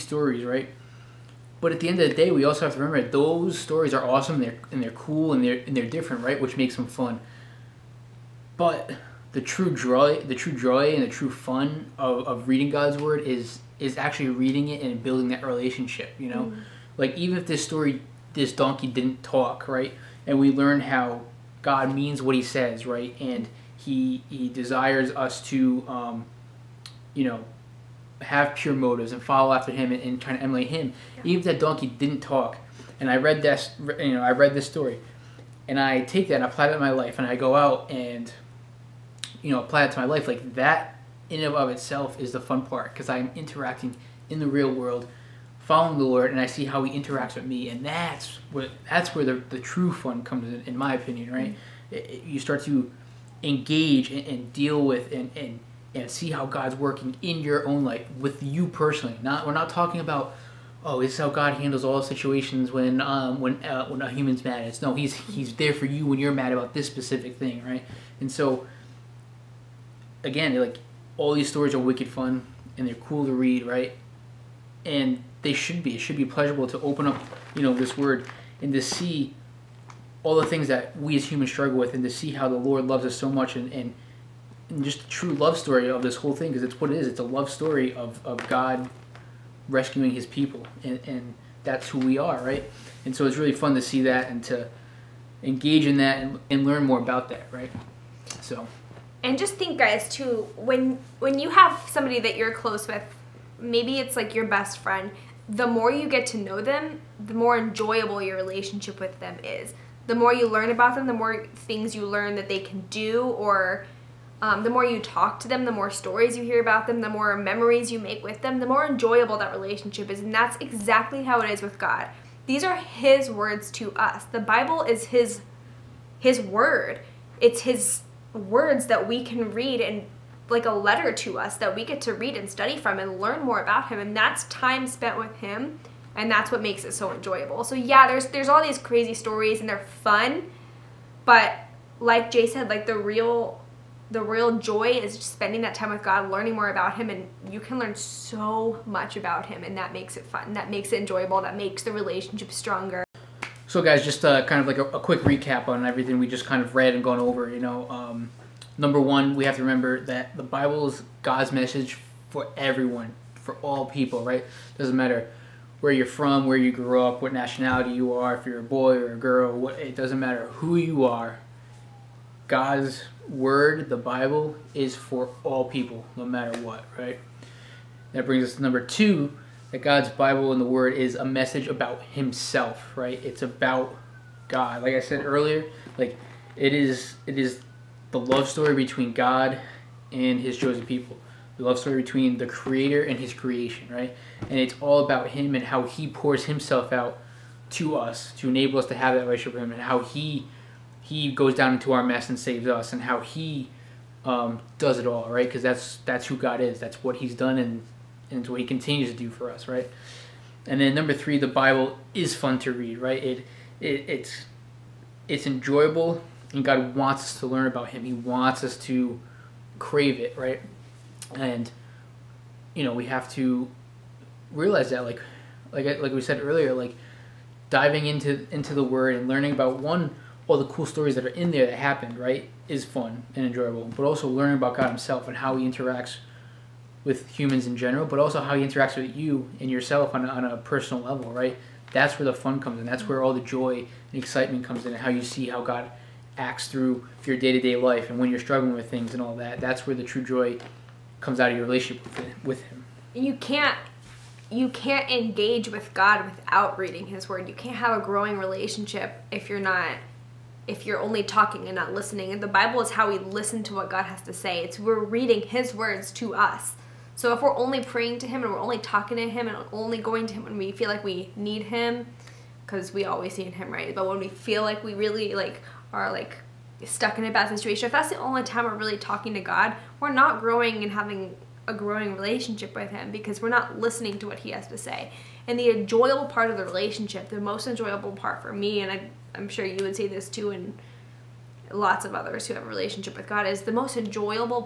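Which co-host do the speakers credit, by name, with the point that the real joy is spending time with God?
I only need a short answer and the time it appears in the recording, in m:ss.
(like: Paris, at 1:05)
Jay, at 2:22.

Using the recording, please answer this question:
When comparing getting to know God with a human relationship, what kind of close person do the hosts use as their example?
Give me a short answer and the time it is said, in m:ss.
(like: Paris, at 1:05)
Best friend, at 1:44.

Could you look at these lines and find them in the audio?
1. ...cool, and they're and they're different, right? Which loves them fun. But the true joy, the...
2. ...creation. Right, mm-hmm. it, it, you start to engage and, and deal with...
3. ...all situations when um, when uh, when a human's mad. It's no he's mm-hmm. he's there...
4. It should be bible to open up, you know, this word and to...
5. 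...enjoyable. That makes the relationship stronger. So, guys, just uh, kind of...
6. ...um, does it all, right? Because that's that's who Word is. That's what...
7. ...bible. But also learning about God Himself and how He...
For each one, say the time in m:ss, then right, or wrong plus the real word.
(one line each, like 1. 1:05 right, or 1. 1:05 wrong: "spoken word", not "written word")
1. 0:04 wrong: "makes", not "loves"
2. 0:50 wrong: "opinion", not "creation"
3. 1:01 right
4. 1:15 wrong: "pleasurable", not "bible"
5. 2:30 right
6. 3:24 wrong: "God", not "Word"
7. 3:53 wrong: "enjoyable", not "bible".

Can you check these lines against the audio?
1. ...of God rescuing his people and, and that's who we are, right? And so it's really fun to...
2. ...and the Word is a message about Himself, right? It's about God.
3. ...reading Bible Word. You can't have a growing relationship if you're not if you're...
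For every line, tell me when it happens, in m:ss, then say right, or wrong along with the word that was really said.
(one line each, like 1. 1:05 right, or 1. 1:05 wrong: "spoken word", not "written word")
1. 1:28 right
2. 3:00 right
3. 4:16 wrong: "His", not "Bible".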